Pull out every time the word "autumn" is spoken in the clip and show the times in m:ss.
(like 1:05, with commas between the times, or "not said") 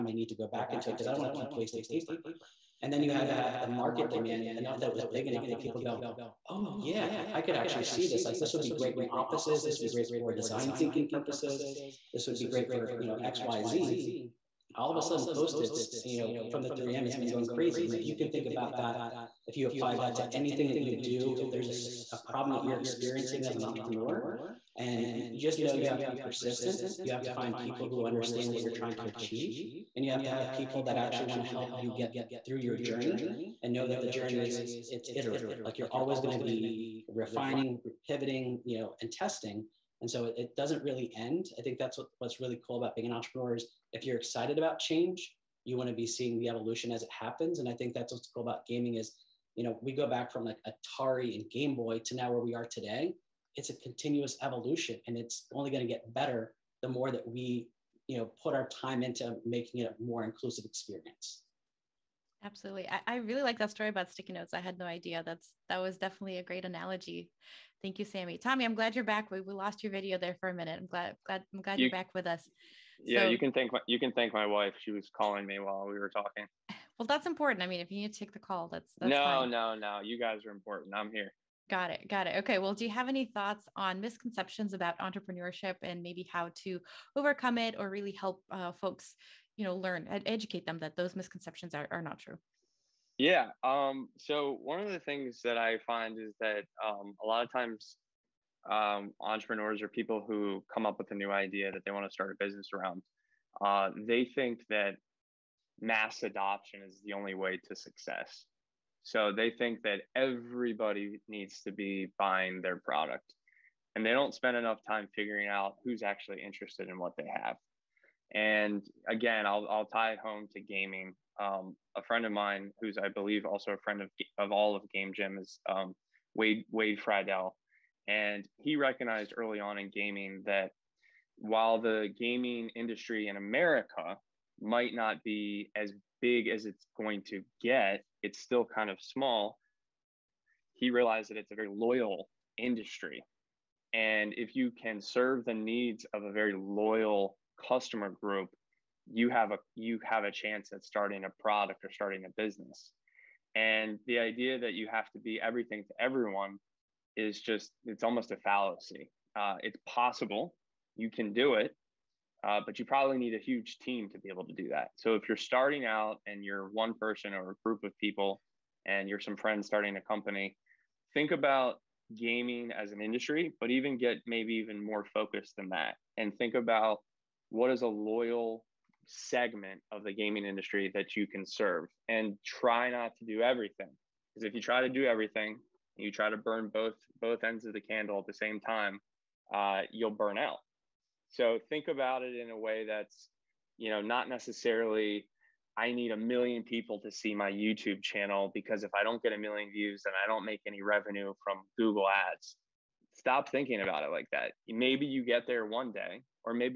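not said.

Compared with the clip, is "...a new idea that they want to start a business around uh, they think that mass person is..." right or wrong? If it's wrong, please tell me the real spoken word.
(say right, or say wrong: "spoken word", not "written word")
wrong: "adoption", not "person".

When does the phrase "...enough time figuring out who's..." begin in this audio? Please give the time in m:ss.
1:54.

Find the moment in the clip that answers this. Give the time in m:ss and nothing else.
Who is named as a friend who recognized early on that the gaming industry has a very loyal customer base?
2:06.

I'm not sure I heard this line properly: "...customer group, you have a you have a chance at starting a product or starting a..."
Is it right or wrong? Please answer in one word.
right.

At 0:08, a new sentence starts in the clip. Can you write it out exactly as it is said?
Like this would be great in offices.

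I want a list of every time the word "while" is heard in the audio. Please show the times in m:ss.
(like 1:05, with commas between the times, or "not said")
1:15, 2:11.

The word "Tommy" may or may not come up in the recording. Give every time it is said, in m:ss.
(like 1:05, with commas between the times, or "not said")
1:08.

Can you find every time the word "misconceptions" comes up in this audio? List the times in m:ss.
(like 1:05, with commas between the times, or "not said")
1:24, 1:31.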